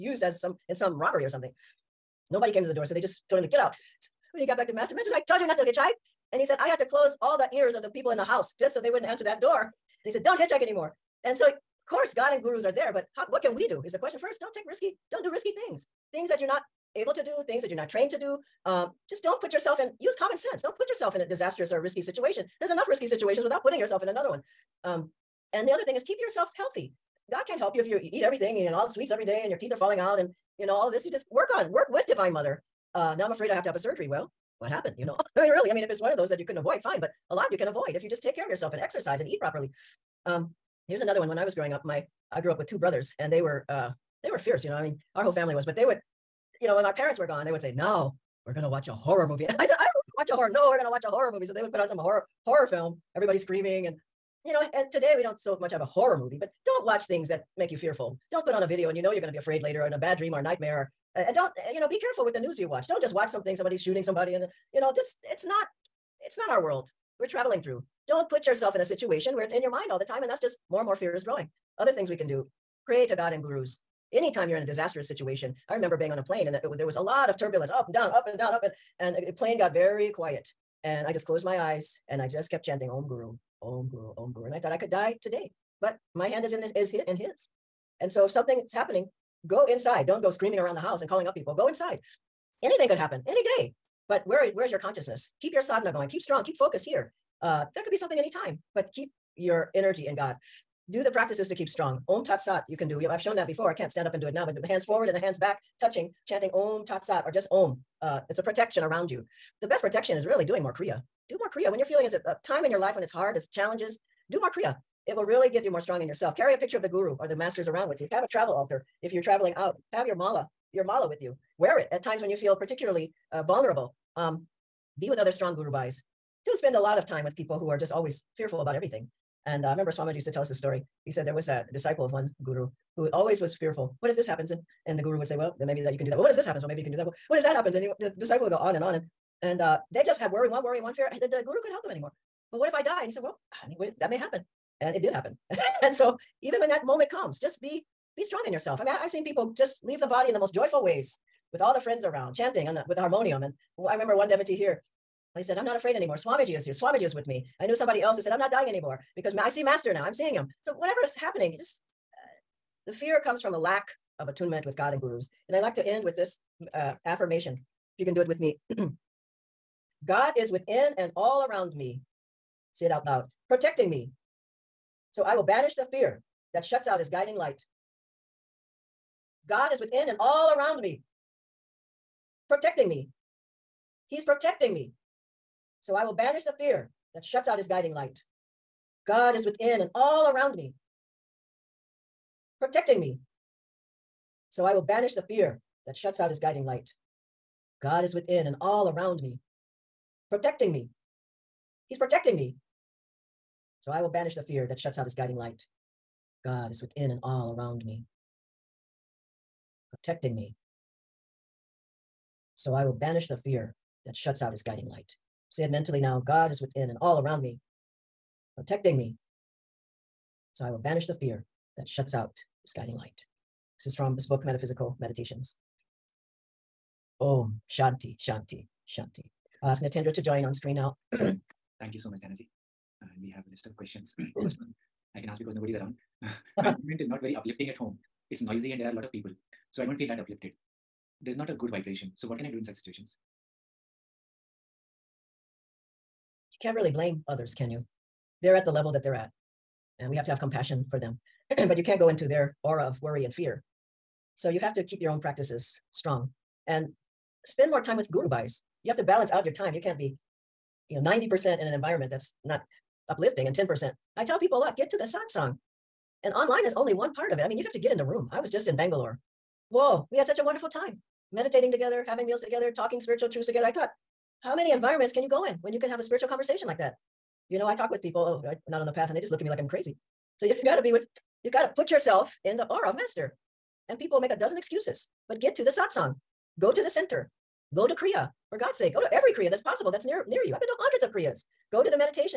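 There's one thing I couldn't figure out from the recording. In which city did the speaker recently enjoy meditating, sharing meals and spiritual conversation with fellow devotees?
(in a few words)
Bangalore.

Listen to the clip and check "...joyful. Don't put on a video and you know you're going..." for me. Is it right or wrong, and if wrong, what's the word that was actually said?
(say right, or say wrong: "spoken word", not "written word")
wrong: "fearful", not "joyful".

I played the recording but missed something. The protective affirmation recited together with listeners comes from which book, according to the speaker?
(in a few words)
Metaphysical Meditations.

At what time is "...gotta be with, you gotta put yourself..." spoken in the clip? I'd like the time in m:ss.
4:40.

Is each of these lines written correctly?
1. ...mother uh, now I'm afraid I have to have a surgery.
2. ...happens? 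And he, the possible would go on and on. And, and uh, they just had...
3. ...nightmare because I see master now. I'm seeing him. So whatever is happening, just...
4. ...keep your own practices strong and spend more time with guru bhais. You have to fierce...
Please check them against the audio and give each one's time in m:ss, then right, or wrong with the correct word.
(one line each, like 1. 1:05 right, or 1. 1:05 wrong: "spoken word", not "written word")
1. 0:32 right
2. 2:17 wrong: "disciple", not "possible"
3. 2:38 wrong: "anymore", not "nightmare"
4. 4:14 wrong: "balance", not "fierce".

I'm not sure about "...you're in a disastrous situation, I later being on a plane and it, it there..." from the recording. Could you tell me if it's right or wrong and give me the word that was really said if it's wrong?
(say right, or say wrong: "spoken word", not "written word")
wrong: "remember", not "later".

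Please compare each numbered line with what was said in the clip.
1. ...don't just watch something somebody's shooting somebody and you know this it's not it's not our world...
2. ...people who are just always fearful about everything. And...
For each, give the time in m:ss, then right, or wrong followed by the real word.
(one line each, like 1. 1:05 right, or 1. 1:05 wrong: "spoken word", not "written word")
1. 1:02 right
2. 2:07 right.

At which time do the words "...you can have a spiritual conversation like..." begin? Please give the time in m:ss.
4:35.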